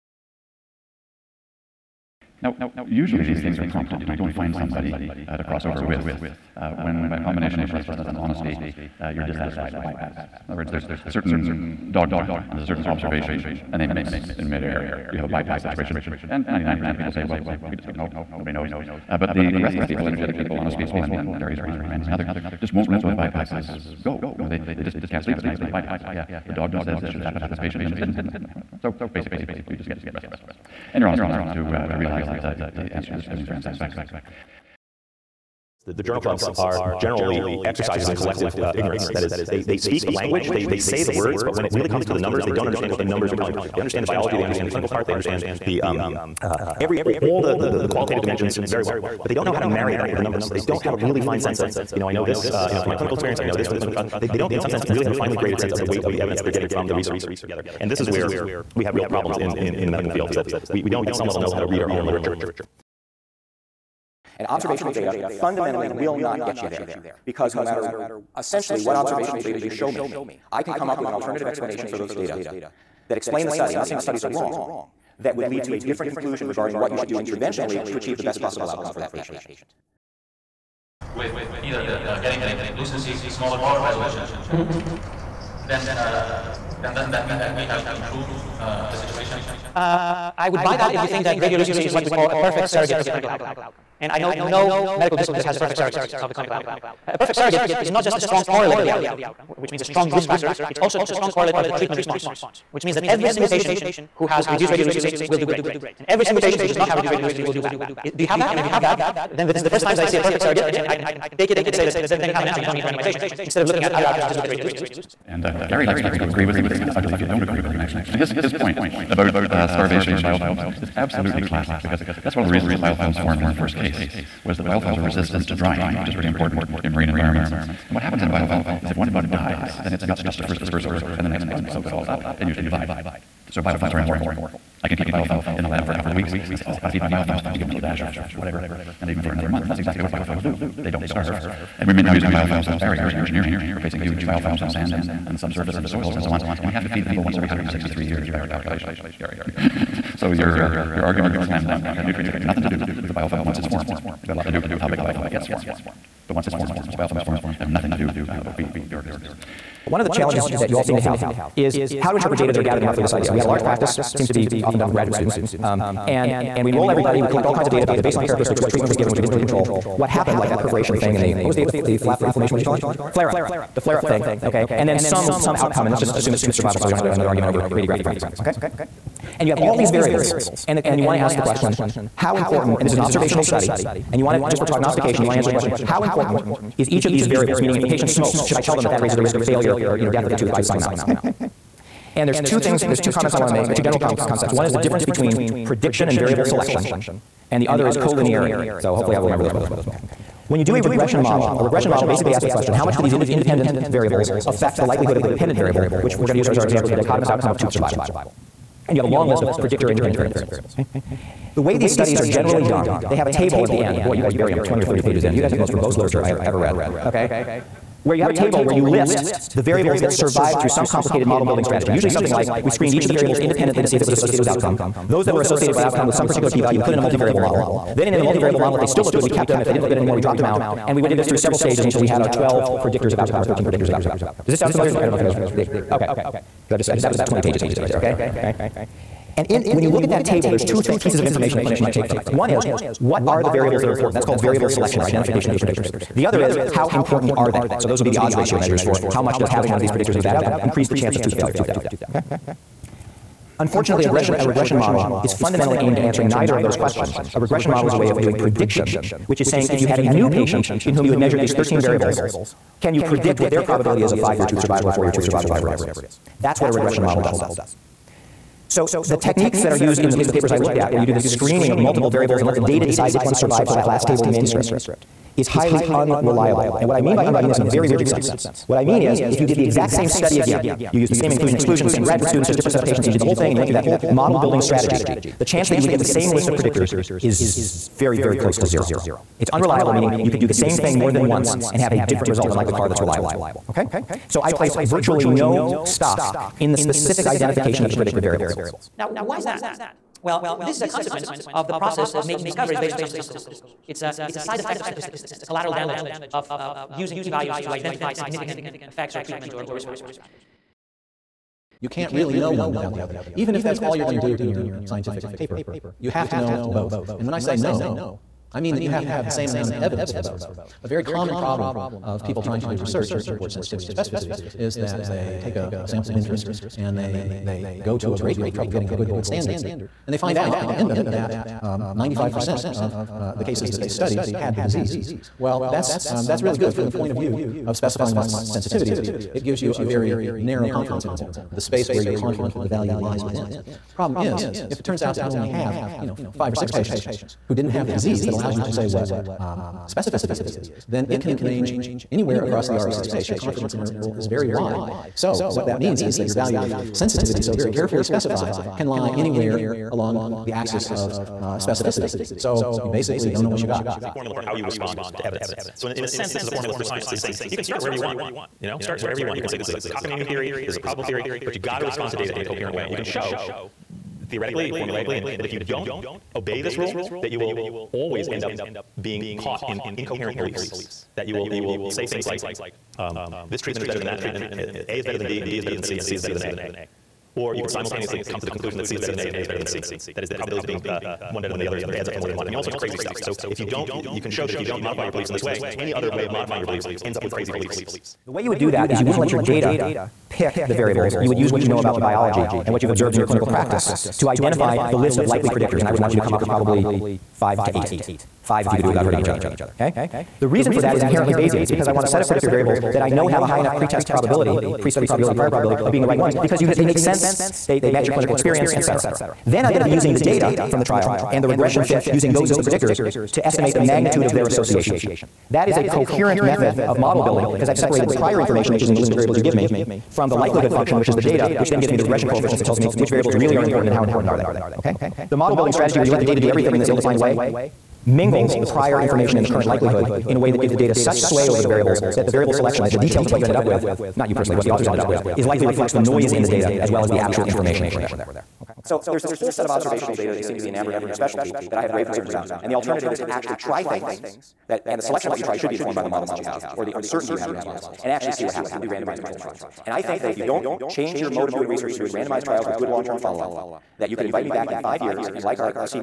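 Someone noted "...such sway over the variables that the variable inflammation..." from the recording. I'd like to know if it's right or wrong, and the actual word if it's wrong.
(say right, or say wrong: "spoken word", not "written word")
wrong: "selection", not "inflammation".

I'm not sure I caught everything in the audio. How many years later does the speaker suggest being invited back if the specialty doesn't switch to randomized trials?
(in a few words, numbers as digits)
5.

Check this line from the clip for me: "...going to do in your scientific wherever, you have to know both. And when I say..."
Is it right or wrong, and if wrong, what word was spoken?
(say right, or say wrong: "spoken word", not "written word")
wrong: "paper", not "wherever".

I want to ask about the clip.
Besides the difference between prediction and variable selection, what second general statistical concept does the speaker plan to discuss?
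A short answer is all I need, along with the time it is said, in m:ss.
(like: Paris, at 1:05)
collinearity, at 3:17.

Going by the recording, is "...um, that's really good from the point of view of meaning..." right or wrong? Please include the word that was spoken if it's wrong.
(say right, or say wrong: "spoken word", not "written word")
wrong: "specifying", not "meaning".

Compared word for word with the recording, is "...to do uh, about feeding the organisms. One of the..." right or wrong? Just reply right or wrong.
right.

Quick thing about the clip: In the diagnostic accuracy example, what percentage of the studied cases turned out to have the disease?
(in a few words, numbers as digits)
95%.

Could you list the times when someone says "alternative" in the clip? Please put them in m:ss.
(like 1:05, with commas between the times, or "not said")
1:11, 7:32.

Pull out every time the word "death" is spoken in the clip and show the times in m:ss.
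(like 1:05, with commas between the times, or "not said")
3:10, 4:11.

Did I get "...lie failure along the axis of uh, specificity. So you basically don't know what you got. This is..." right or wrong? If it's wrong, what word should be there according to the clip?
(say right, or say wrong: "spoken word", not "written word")
wrong: "anywhere", not "failure".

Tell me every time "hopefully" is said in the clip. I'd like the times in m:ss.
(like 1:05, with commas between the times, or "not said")
3:18.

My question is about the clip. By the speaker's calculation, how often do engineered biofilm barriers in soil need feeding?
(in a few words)
every 163 years.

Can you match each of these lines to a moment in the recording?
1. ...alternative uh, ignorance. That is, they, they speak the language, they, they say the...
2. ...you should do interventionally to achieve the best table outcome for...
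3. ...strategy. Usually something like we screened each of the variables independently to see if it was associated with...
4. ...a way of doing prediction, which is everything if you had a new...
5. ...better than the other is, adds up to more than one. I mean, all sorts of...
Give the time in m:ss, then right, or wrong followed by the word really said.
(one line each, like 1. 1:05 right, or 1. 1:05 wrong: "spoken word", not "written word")
1. 0:38 wrong: "collective", not "alternative"
2. 1:16 wrong: "possible", not "table"
3. 3:41 right
4. 4:17 wrong: "saying", not "everything"
5. 6:31 right.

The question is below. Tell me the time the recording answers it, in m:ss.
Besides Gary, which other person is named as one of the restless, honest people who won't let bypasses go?
0:21.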